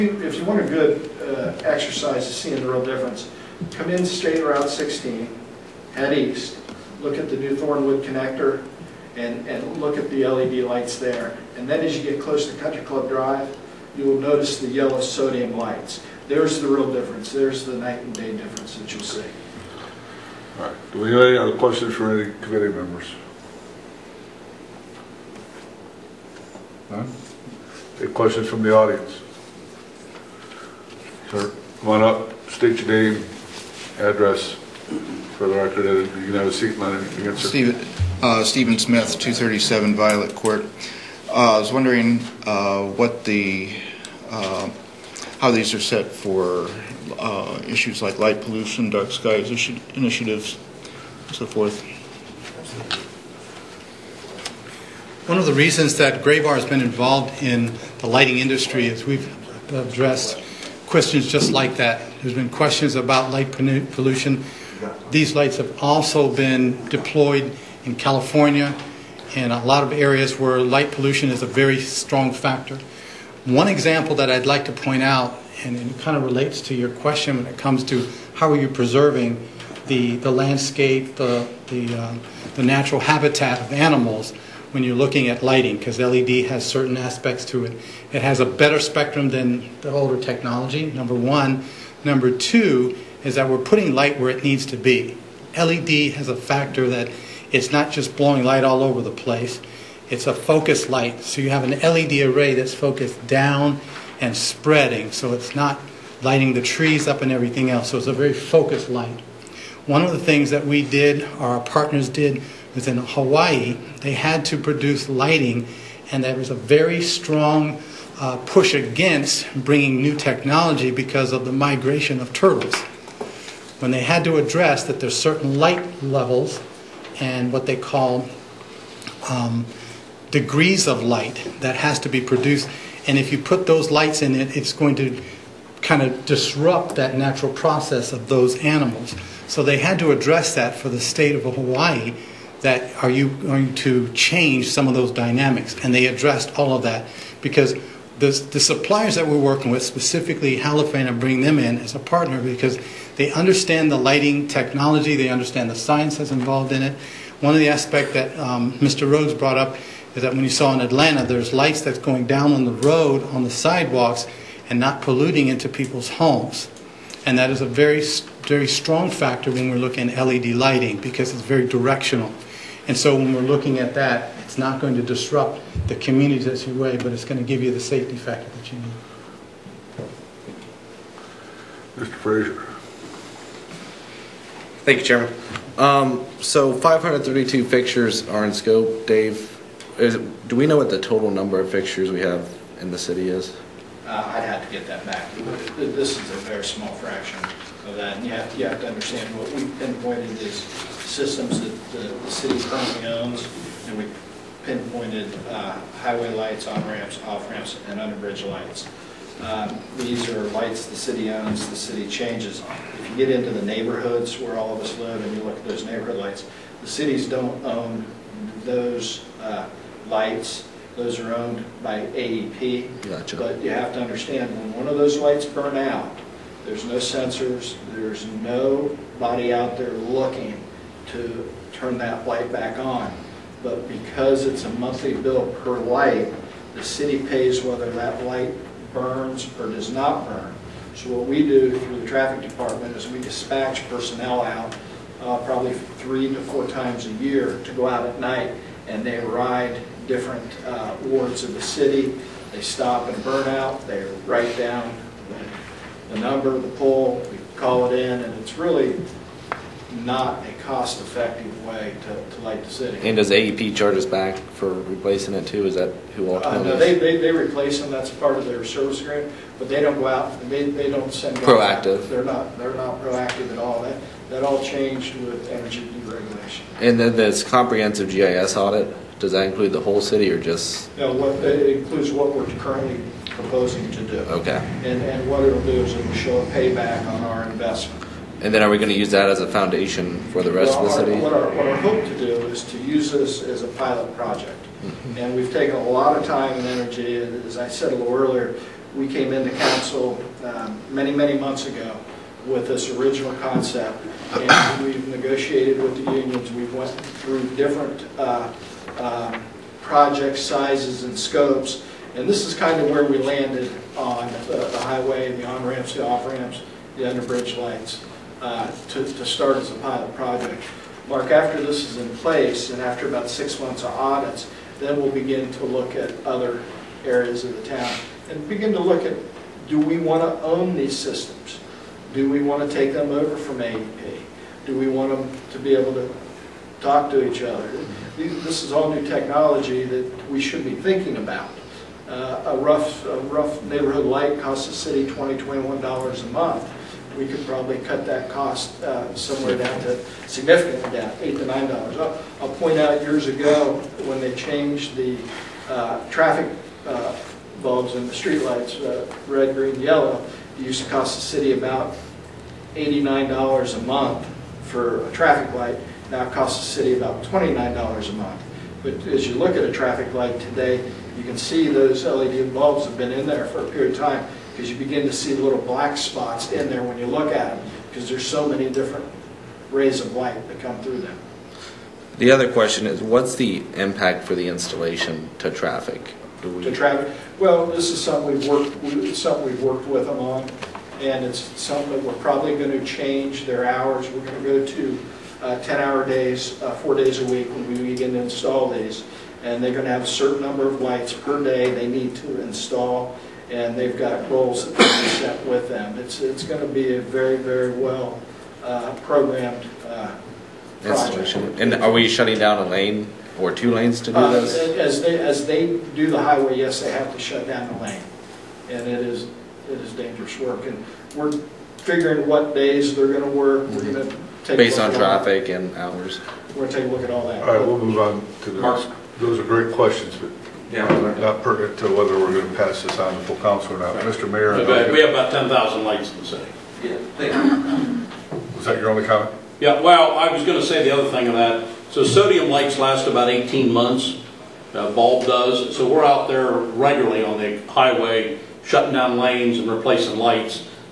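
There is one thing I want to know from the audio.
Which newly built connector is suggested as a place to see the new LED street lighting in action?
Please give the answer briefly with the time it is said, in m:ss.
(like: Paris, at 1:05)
Thornwood connector, at 0:07.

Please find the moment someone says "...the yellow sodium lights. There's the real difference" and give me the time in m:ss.
0:14.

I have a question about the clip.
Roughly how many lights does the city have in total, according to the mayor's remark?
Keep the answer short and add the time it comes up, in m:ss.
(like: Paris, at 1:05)
10,000, at 7:15.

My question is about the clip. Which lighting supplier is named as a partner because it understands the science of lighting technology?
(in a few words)
Holophane.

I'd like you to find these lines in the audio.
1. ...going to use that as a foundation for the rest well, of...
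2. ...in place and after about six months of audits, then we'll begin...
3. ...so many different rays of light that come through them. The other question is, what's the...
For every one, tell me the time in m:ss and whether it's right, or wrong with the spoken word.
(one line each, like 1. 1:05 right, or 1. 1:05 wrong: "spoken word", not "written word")
1. 4:48 right
2. 5:21 right
3. 6:18 right.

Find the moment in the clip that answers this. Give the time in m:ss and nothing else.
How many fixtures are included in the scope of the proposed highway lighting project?
3:06.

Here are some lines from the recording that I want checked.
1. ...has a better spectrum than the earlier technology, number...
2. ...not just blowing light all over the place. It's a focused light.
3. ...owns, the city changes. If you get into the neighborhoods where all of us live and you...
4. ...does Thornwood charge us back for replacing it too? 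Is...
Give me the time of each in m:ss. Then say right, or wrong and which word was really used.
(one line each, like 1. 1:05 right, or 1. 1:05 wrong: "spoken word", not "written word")
1. 1:28 wrong: "older", not "earlier"
2. 1:37 right
3. 3:31 right
4. 4:23 wrong: "AEP", not "Thornwood".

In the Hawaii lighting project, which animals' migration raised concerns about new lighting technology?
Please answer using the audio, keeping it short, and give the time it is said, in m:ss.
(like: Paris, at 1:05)
Turtles, at 2:02.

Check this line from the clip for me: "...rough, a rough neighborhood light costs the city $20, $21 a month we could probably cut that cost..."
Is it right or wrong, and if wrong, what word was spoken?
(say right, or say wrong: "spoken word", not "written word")
right.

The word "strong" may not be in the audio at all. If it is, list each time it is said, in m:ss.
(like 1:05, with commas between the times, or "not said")
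1:11, 1:57, 2:48.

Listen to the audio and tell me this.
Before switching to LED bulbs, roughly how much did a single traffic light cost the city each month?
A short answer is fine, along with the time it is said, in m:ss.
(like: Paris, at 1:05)
$89, at 6:02.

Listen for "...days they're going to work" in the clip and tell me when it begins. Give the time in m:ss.
7:02.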